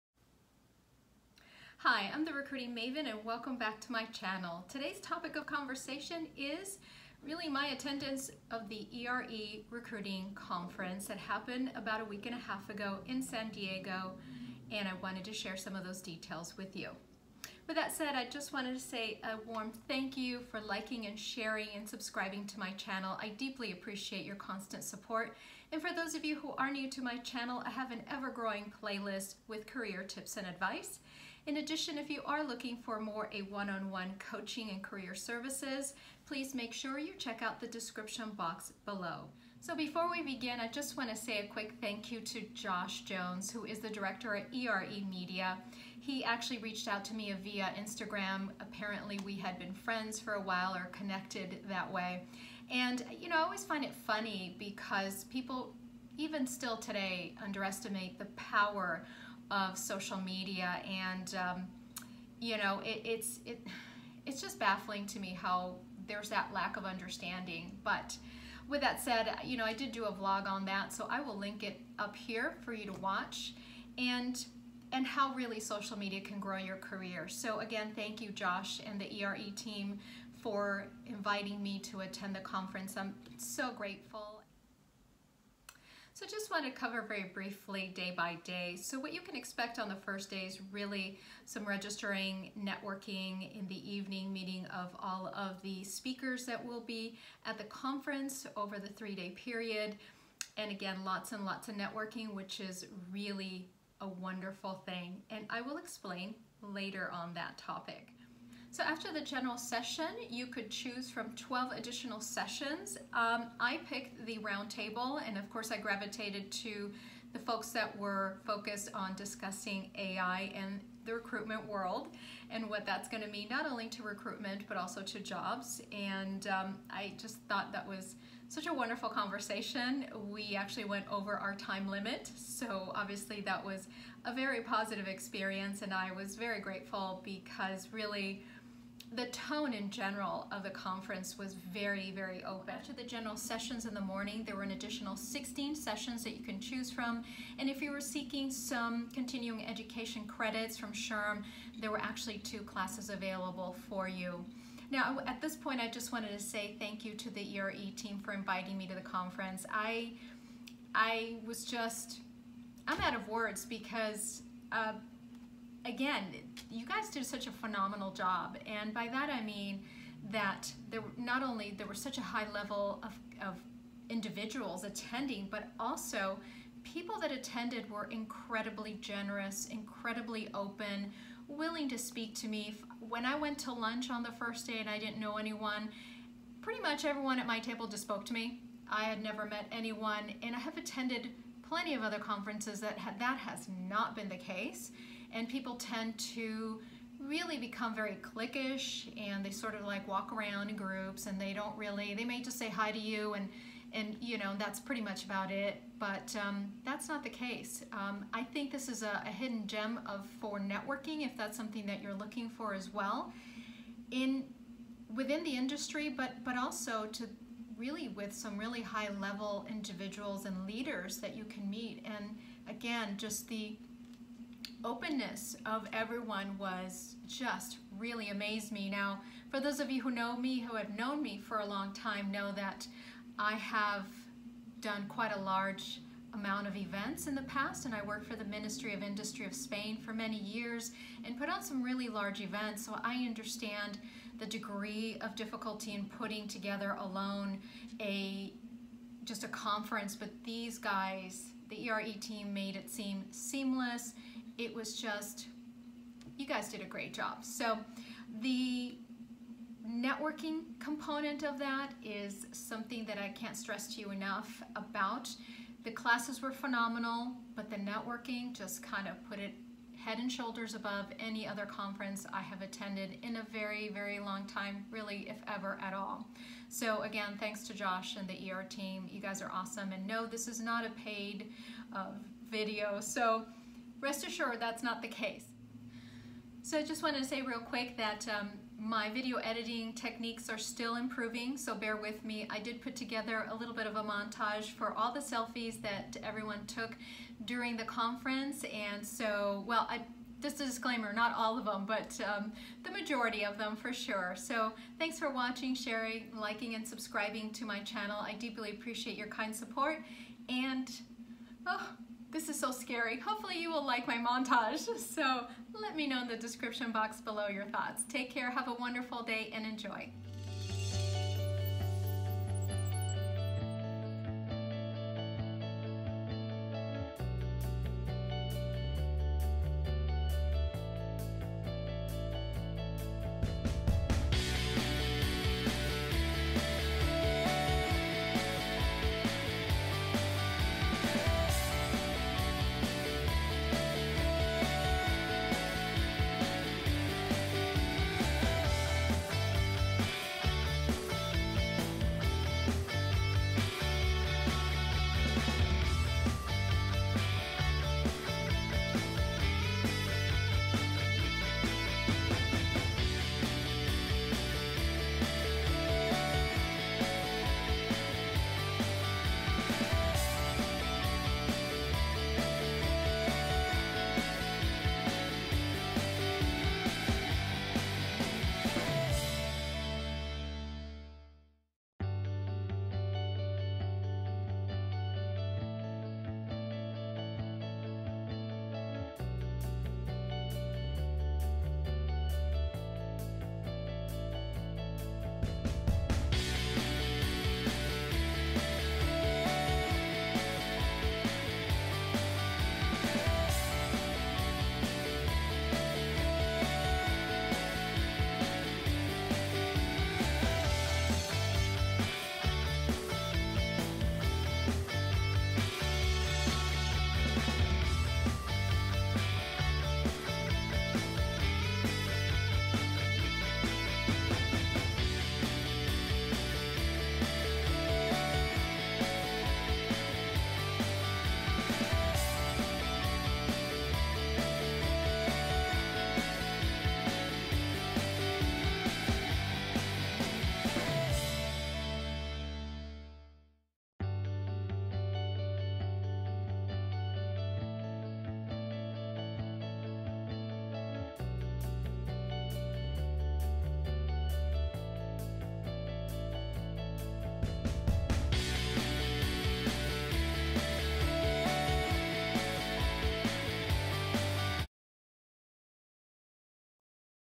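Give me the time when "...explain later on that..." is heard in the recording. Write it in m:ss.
1:45.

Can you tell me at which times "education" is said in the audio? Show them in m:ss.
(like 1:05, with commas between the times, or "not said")
2:29.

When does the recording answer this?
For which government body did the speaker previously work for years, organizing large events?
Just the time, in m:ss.
3:58.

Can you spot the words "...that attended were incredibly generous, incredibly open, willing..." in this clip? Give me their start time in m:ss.
2:57.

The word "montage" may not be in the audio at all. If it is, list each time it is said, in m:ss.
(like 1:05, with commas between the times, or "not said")
4:54, 5:14.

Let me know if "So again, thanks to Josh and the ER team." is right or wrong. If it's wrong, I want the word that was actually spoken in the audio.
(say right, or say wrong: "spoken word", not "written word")
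right.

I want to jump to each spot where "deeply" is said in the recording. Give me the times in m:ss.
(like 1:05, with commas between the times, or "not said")
0:23, 5:08.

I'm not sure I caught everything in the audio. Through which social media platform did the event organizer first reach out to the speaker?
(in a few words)
Instagram.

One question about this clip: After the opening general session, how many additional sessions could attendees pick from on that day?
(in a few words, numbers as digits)
12.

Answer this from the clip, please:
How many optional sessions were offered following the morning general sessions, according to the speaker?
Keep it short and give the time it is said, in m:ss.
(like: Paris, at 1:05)
16, at 2:25.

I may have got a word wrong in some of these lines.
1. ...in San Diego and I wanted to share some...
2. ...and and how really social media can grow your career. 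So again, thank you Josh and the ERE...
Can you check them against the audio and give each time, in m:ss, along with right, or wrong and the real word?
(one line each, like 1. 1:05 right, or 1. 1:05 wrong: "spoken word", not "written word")
1. 0:13 right
2. 1:13 right.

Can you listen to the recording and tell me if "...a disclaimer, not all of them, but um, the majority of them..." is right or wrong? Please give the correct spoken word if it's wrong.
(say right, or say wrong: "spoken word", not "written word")
right.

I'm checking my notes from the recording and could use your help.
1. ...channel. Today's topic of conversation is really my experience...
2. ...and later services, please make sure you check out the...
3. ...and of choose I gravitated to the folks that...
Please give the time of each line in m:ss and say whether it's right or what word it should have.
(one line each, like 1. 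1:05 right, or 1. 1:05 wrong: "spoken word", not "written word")
1. 0:04 wrong: "attendance", not "experience"
2. 0:34 wrong: "career", not "later"
3. 1:55 wrong: "course", not "choose".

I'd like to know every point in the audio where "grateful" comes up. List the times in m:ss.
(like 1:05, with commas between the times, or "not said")
1:23, 2:16.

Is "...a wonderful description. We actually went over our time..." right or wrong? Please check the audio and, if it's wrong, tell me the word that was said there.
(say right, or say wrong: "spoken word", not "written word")
wrong: "conversation", not "description".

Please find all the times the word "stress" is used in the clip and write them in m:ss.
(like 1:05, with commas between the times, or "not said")
4:23.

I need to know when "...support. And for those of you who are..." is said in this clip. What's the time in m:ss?
0:24.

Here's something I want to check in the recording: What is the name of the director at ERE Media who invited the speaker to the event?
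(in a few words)
Josh Jones.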